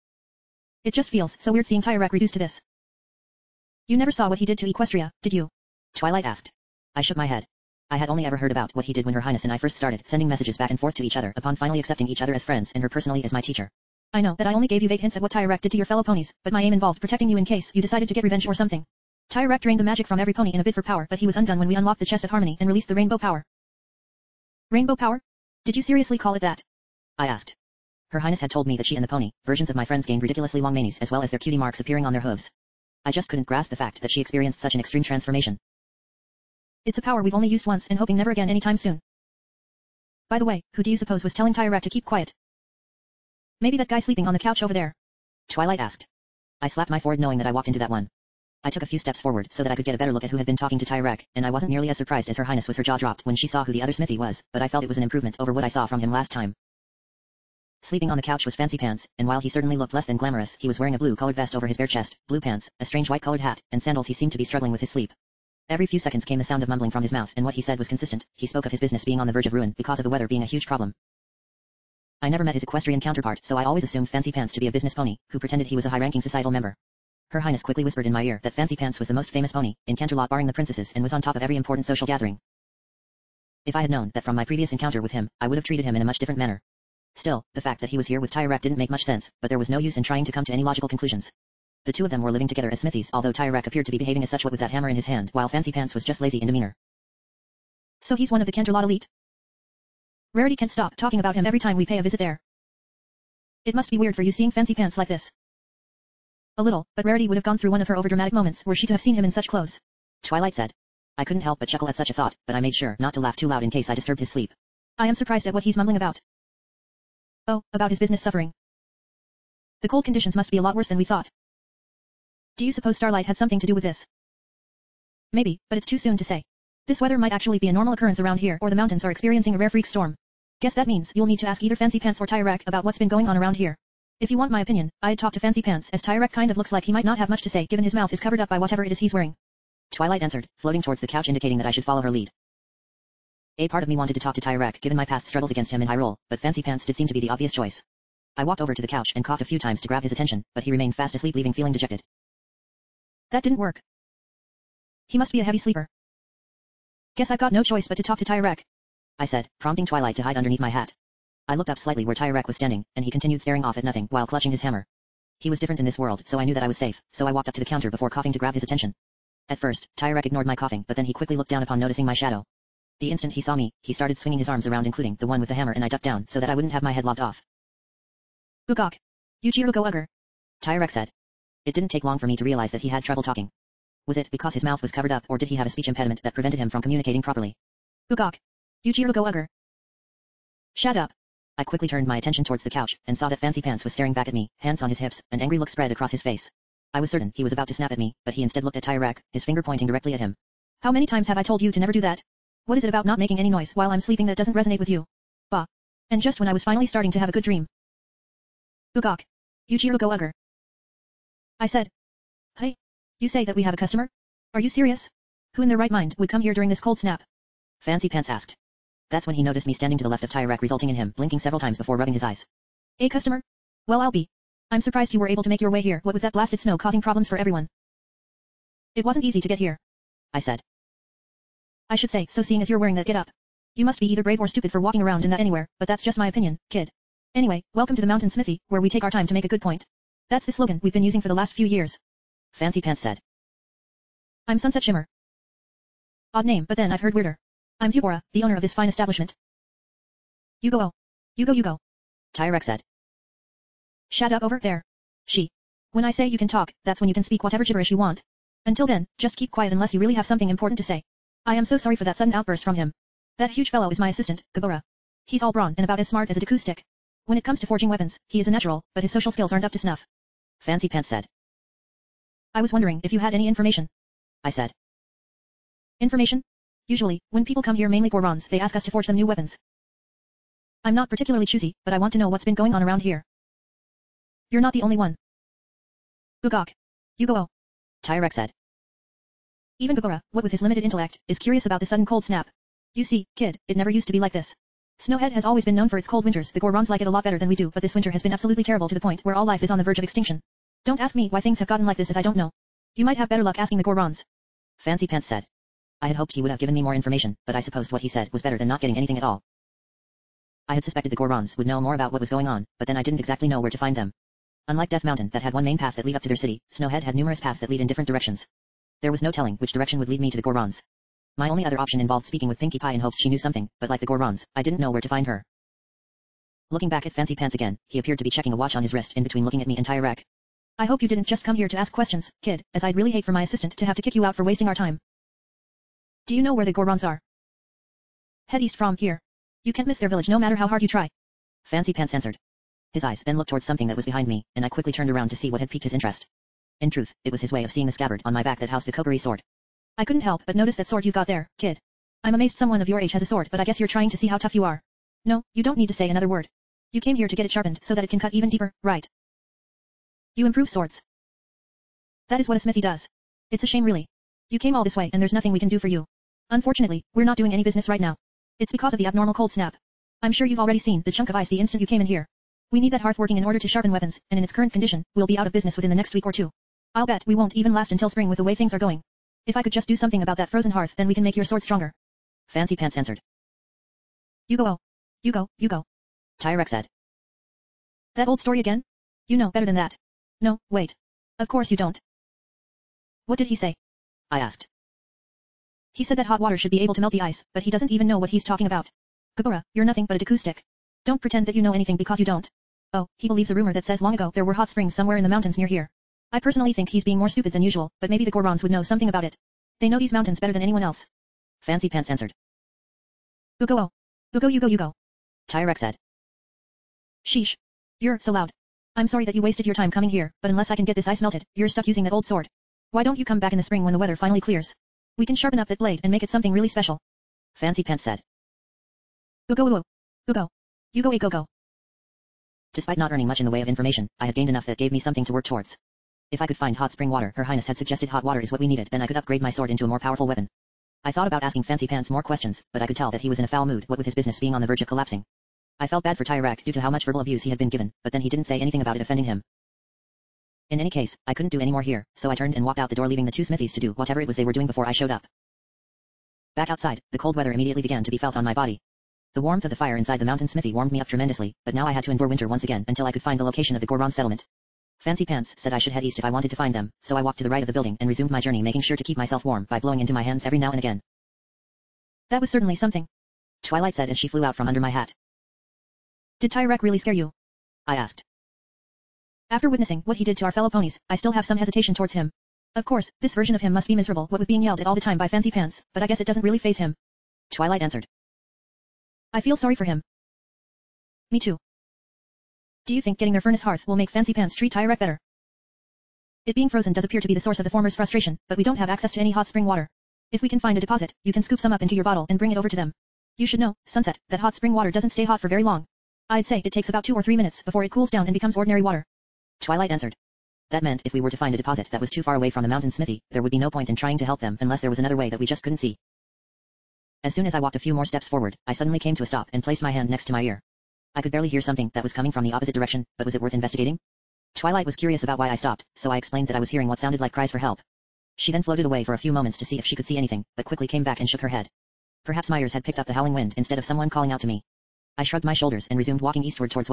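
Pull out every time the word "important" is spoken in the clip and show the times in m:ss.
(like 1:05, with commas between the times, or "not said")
1:21, 4:20.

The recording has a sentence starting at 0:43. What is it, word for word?
Maybe that guy sleeping on the couch over there.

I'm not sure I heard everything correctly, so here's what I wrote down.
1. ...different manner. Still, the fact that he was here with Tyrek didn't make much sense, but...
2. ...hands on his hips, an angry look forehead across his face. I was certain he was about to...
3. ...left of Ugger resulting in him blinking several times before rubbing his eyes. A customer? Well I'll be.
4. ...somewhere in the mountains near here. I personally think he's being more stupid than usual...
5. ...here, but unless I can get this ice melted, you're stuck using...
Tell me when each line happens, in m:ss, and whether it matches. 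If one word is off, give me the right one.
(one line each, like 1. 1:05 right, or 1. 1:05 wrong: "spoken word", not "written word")
1. 1:26 right
2. 3:14 wrong: "spread", not "forehead"
3. 3:40 wrong: "Tirek", not "Ugger"
4. 6:44 right
5. 7:00 right.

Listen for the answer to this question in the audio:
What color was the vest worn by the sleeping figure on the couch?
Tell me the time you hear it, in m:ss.
1:00.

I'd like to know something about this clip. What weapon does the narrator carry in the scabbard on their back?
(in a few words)
Kokiri sword.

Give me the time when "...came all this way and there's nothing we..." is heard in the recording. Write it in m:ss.
6:04.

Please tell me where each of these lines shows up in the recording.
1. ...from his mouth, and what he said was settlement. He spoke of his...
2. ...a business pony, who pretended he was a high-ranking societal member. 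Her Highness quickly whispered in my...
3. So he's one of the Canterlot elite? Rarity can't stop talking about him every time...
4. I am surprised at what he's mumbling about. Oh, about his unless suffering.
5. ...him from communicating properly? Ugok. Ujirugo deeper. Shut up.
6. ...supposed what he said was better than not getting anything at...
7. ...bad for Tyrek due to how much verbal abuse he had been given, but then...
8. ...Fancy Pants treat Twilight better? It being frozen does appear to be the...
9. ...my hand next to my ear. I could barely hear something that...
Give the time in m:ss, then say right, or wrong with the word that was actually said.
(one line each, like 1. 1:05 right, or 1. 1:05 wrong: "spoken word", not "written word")
1. 1:06 wrong: "consistent", not "settlement"
2. 1:14 right
3. 1:38 right
4. 1:54 wrong: "business", not "unless"
5. 3:06 wrong: "ugger", not "deeper"
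6. 5:07 right
7. 7:26 right
8. 8:14 wrong: "Tyrek", not "Twilight"
9. 8:39 right.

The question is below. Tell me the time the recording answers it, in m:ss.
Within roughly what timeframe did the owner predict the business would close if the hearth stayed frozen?
6:15.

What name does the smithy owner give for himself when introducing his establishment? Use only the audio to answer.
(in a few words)
Zubora.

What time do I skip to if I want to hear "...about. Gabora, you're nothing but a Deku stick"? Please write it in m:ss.
6:38.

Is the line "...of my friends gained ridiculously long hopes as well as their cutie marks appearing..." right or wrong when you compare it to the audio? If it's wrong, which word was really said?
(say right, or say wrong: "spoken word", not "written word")
wrong: "manies", not "hopes".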